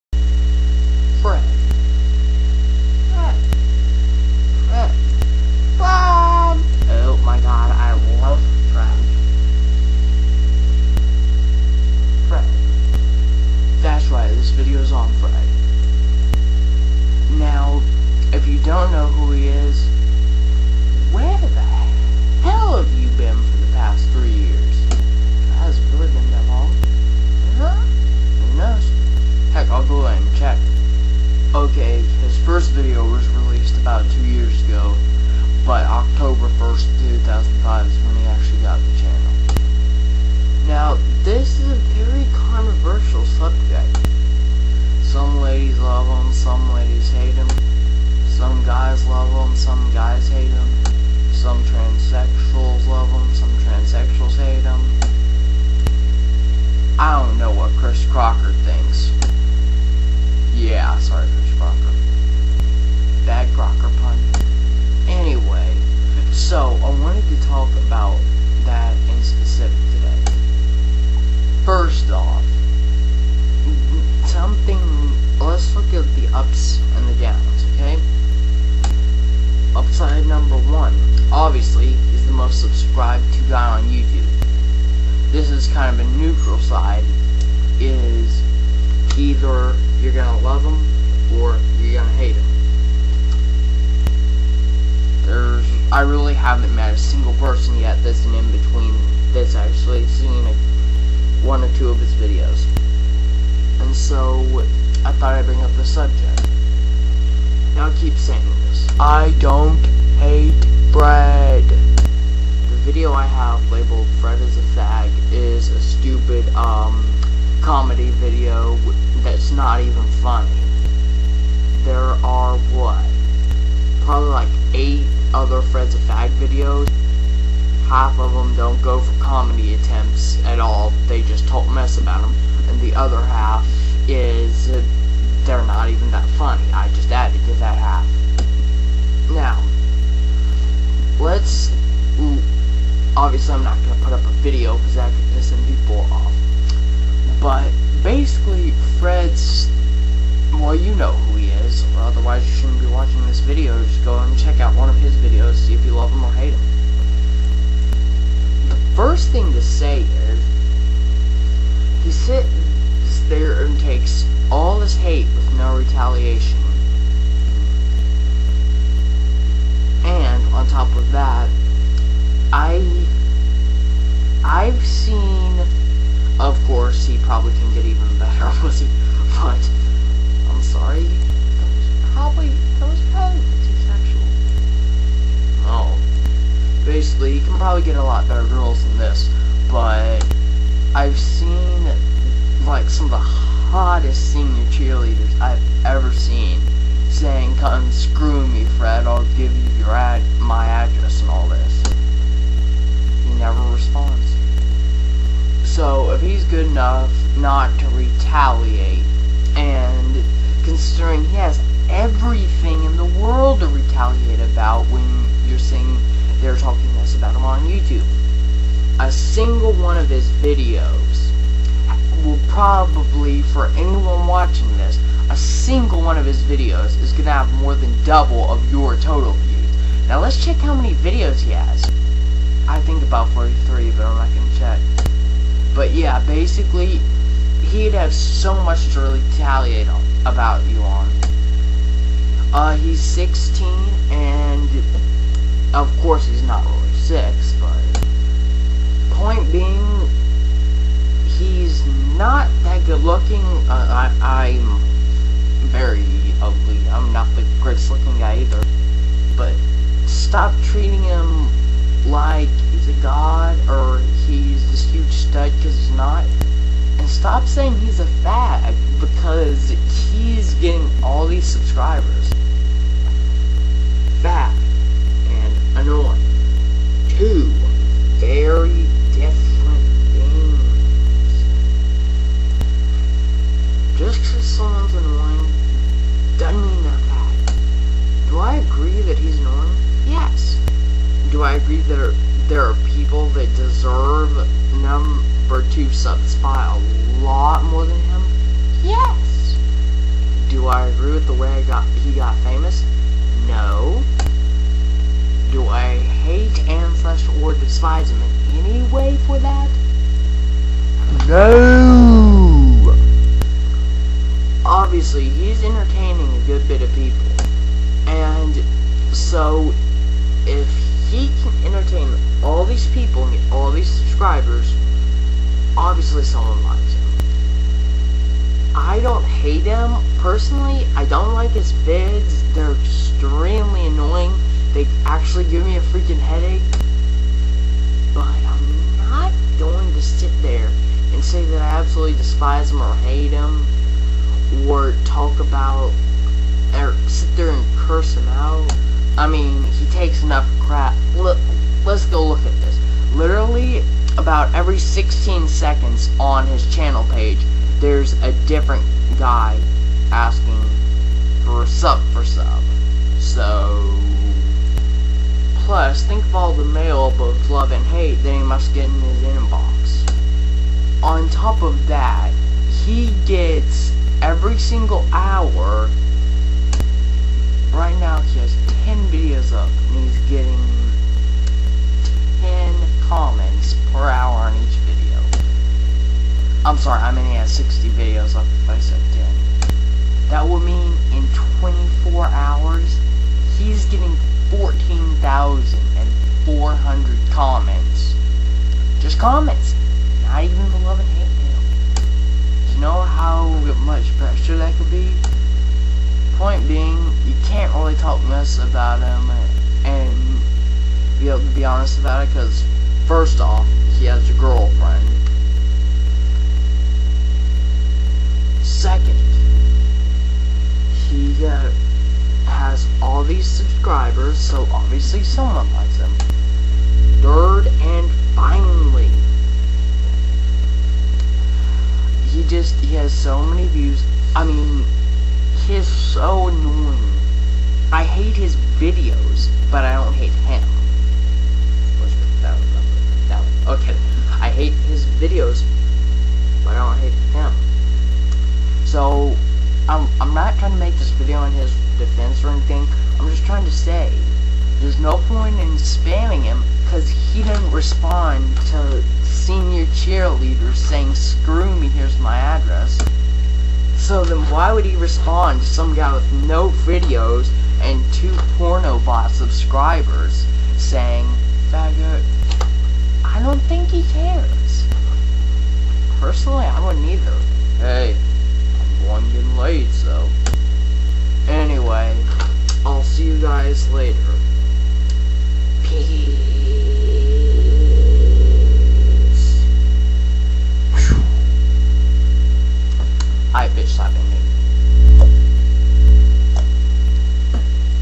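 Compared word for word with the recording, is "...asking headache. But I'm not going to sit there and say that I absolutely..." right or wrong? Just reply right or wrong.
wrong.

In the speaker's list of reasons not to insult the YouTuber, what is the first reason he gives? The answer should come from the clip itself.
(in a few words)
he has a girlfriend.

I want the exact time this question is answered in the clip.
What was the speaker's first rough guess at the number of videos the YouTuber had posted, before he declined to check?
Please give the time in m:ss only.
3:53.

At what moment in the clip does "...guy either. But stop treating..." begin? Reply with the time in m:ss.
4:18.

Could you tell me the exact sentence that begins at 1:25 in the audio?
This is kind of a neutral side, is either you're going to love him or you're going to hate him.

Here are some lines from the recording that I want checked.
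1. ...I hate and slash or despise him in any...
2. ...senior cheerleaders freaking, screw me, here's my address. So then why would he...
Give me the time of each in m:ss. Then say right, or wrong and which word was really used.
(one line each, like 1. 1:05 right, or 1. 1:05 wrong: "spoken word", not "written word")
1. 5:05 right
2. 7:39 wrong: "saying", not "freaking".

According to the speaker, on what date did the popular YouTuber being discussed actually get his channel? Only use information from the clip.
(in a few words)
October 1st, 2005.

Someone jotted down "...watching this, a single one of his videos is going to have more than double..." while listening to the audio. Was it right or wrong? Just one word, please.
right.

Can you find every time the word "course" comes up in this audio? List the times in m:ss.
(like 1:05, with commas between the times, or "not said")
2:56, 4:06.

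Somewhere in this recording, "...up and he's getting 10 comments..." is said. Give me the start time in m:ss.
6:19.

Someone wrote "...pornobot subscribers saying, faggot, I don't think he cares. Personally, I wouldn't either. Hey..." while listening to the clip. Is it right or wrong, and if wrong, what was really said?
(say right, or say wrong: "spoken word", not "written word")
right.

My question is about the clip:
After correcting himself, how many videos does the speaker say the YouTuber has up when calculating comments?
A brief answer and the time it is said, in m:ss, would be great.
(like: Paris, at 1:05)
60, at 6:27.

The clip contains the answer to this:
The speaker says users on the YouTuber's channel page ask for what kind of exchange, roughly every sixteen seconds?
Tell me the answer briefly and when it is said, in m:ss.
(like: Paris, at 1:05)
sub for sub, at 6:01.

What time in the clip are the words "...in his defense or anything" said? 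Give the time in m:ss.
7:31.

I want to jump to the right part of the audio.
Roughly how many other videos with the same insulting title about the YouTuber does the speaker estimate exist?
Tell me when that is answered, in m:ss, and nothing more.
2:04.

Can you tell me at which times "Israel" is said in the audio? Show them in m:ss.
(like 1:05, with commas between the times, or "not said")
not said.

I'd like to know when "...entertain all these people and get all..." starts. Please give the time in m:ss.
5:21.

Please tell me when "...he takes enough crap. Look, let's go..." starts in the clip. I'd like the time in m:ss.
5:49.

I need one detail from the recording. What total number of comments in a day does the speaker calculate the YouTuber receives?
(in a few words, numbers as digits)
14,400.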